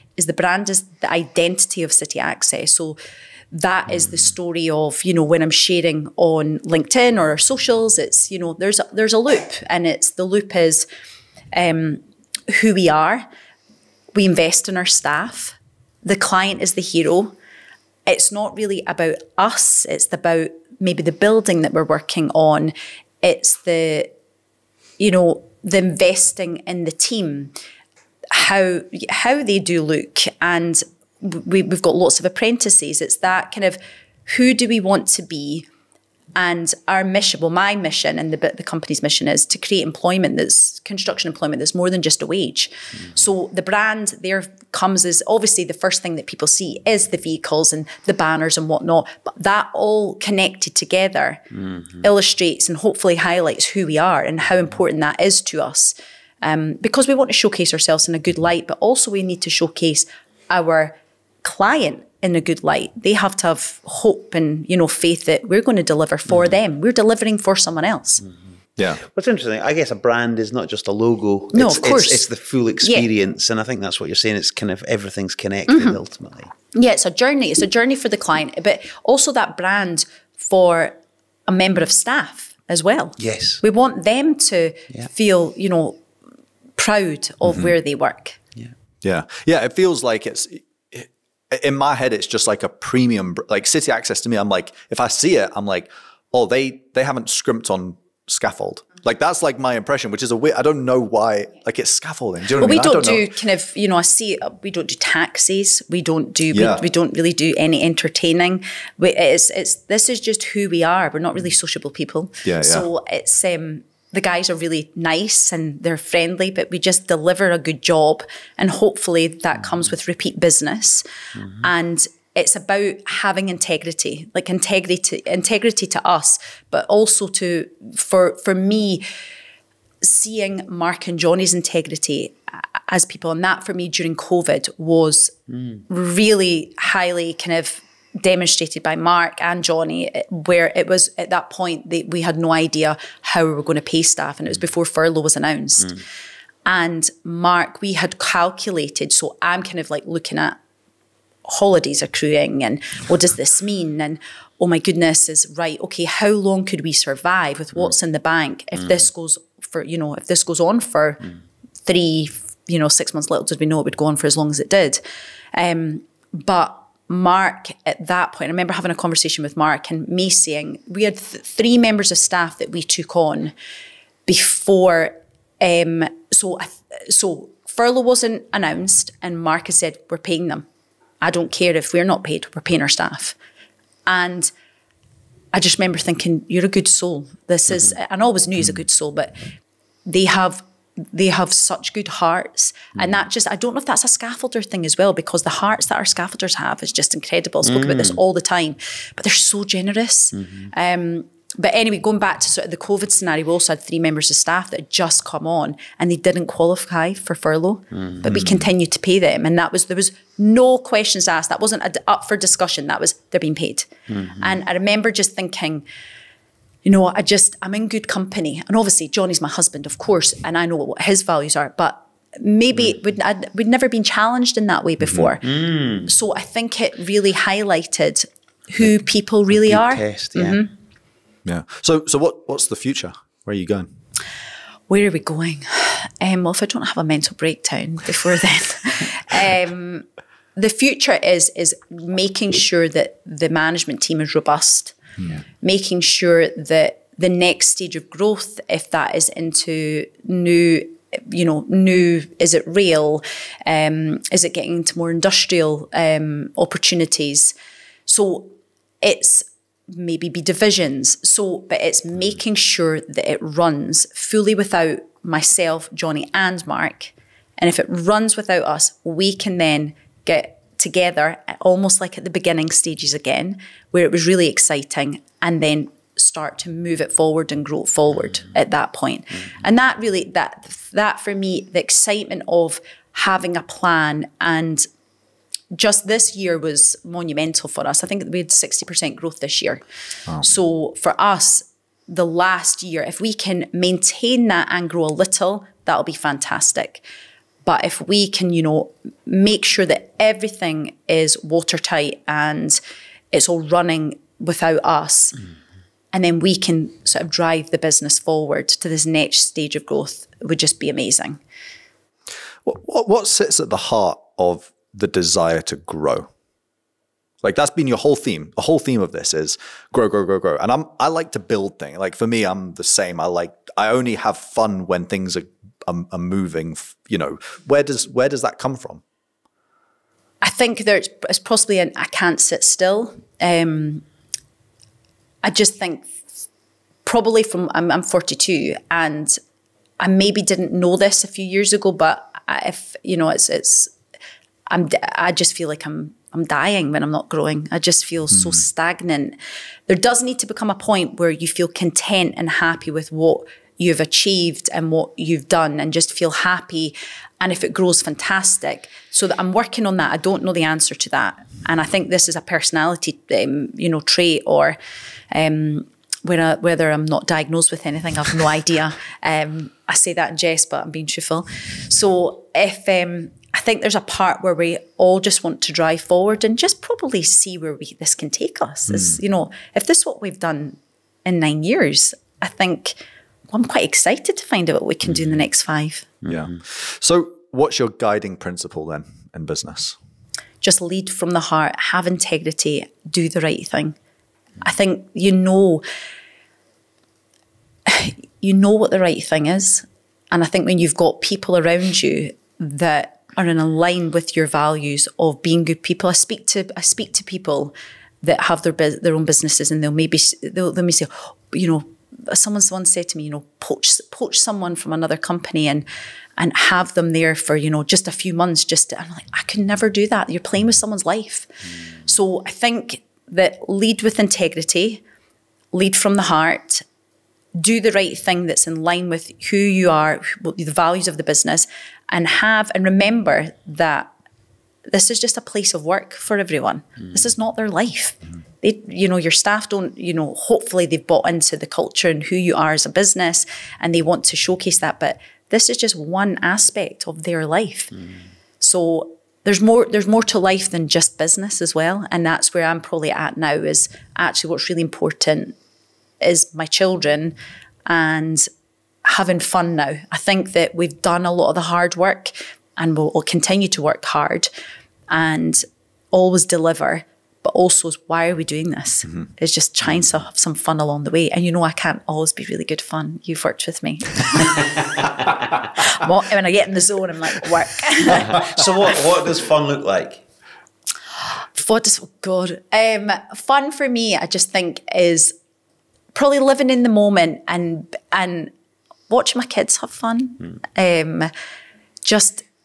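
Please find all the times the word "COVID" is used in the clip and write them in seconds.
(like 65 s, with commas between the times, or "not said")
134 s, 202 s.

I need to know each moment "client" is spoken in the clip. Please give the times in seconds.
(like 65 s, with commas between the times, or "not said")
16 s, 61 s, 78 s.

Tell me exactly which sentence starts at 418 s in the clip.
Just to, I'm like, I can never do that.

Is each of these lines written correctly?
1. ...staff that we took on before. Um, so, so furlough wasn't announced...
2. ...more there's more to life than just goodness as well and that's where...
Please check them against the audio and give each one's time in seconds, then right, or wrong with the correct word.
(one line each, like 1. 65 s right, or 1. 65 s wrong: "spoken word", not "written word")
1. 172 s right
2. 449 s wrong: "business", not "goodness".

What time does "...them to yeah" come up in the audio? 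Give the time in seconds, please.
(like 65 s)
84 s.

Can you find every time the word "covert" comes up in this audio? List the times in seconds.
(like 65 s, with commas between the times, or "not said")
not said.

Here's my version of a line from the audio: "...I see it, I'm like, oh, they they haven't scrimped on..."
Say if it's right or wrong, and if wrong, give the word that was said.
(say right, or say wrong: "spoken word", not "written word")
right.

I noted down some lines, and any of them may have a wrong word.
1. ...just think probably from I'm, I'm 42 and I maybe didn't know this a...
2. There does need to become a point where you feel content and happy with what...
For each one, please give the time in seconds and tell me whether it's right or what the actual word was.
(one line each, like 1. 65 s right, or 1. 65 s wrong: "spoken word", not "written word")
1. 335 s right
2. 349 s right.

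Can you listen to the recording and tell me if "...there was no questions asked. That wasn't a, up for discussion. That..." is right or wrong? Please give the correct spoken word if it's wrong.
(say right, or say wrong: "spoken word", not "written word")
right.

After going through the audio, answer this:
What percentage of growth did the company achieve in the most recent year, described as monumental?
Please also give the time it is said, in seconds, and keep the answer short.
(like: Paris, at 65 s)
60%, at 288 s.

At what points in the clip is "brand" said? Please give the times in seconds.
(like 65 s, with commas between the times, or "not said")
0 s, 43 s, 69 s, 79 s.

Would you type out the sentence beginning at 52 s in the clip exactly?
illustrates and hopefully highlights who we are and how important that is to us.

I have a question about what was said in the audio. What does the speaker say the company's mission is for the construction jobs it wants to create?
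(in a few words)
More than just a wage.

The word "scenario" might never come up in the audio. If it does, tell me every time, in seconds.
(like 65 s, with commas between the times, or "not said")
203 s.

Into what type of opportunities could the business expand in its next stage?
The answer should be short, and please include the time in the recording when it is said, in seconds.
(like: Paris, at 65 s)
Industrial, at 255 s.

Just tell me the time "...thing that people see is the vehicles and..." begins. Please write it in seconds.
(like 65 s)
46 s.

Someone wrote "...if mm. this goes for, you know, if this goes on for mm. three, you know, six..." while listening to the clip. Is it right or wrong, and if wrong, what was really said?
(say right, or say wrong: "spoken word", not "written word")
right.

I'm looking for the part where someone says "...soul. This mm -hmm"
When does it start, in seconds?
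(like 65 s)
186 s.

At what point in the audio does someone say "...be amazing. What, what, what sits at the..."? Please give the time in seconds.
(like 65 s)
310 s.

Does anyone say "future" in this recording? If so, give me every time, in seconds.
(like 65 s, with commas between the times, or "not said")
232 s, 240 s.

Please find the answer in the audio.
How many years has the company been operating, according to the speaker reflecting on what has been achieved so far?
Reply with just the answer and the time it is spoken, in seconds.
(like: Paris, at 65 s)
9, at 381 s.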